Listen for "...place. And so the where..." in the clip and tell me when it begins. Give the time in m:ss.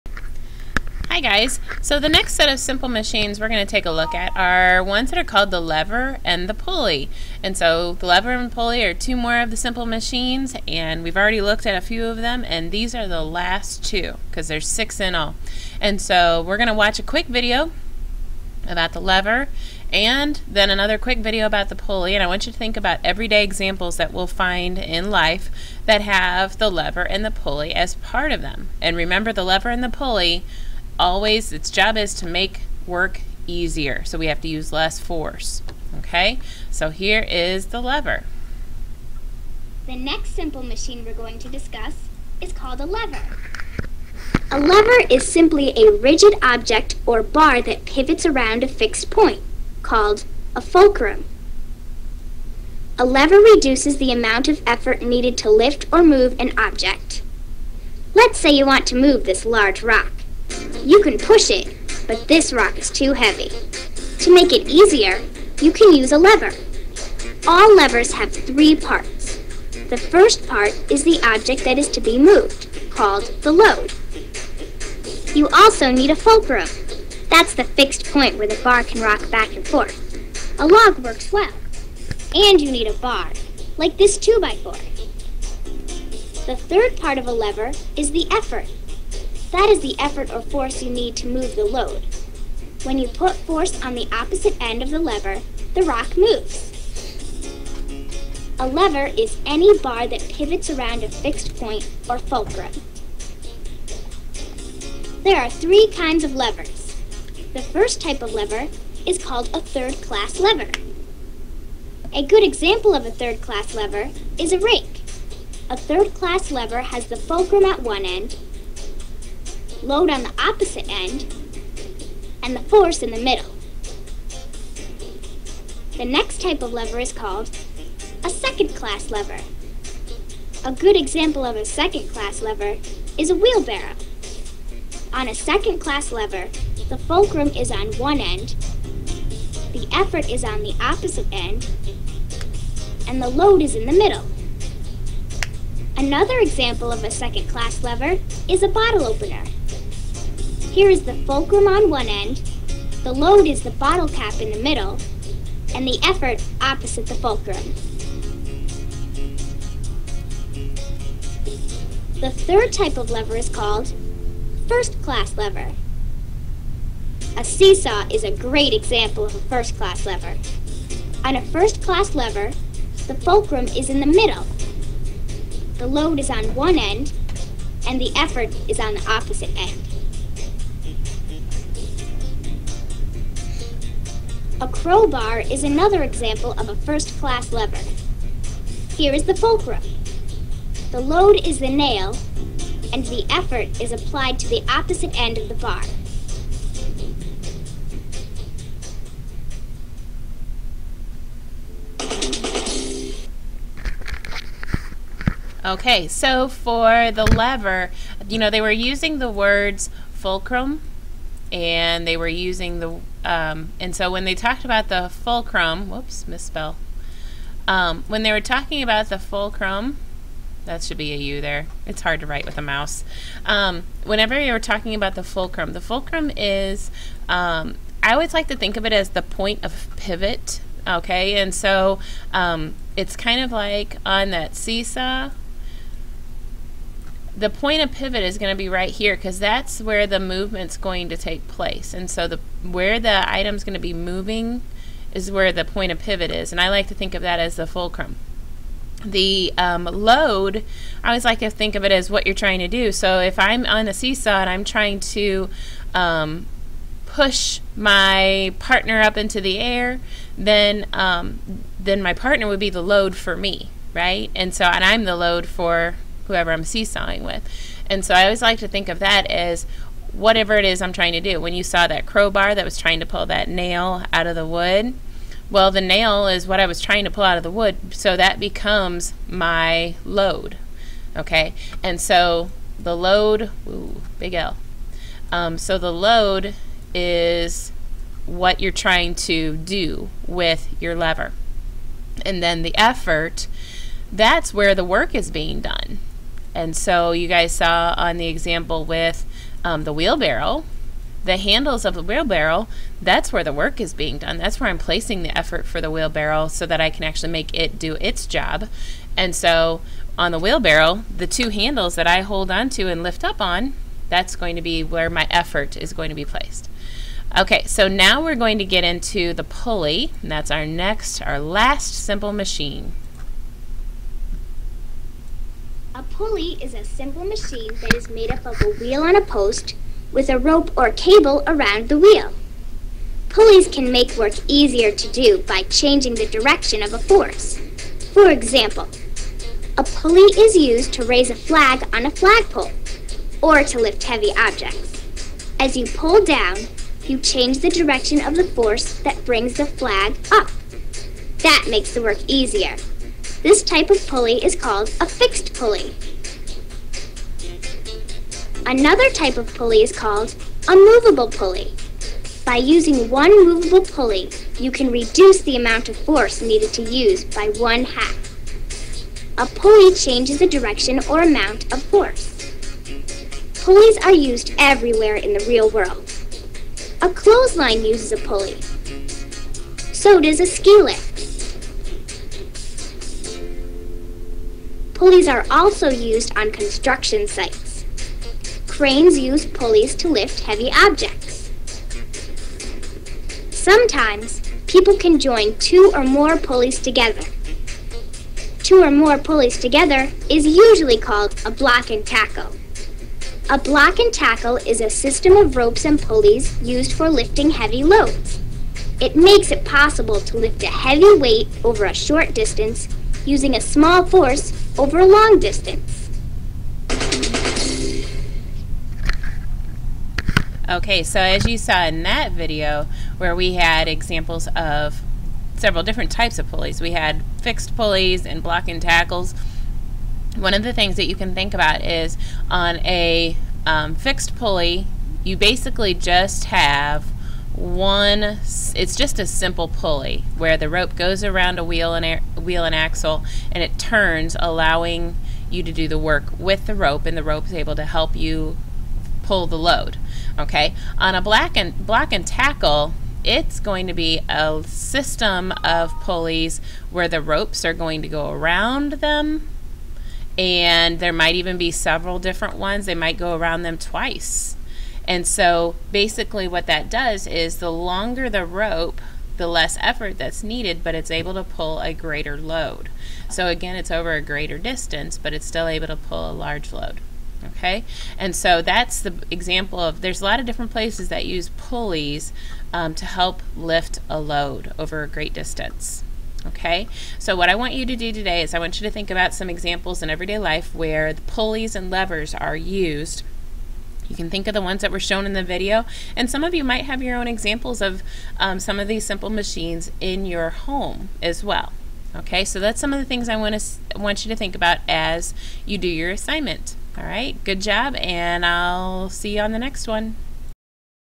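4:01.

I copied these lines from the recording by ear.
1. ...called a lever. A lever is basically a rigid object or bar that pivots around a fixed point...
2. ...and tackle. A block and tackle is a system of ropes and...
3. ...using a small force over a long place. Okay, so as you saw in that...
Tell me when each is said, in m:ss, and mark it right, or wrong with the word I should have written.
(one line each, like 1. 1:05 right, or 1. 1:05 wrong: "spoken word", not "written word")
1. 0:42 wrong: "simply", not "basically"
2. 6:41 right
3. 6:53 wrong: "distance", not "place".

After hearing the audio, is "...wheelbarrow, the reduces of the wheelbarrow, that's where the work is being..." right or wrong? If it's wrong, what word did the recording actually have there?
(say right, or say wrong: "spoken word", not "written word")
wrong: "handles", not "reduces".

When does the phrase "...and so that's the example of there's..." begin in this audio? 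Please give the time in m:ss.
7:58.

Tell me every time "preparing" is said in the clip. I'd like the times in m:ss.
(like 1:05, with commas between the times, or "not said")
not said.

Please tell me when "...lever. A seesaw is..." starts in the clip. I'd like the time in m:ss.
2:45.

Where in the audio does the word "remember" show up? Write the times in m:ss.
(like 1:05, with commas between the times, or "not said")
0:28.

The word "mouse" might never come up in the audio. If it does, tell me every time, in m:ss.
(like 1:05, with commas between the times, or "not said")
3:42.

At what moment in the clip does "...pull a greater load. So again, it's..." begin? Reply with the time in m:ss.
7:51.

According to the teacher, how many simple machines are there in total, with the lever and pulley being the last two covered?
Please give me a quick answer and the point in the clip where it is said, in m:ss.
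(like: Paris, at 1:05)
6, at 0:14.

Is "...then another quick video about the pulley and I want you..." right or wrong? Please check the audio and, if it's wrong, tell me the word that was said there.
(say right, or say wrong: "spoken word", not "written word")
right.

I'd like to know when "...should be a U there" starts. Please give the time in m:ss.
3:40.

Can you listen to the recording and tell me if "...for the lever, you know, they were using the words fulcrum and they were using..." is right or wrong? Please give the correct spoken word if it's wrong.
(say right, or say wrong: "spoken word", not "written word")
right.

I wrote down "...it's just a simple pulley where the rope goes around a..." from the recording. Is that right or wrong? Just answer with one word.
right.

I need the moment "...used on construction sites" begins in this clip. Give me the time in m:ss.
6:25.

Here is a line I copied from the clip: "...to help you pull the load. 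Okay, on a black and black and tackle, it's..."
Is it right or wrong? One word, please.
wrong.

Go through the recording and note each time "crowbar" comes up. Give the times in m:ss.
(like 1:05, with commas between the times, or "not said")
3:04, 4:32.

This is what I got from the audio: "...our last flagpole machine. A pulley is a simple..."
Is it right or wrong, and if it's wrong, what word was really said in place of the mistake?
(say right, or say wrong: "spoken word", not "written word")
wrong: "simple", not "flagpole".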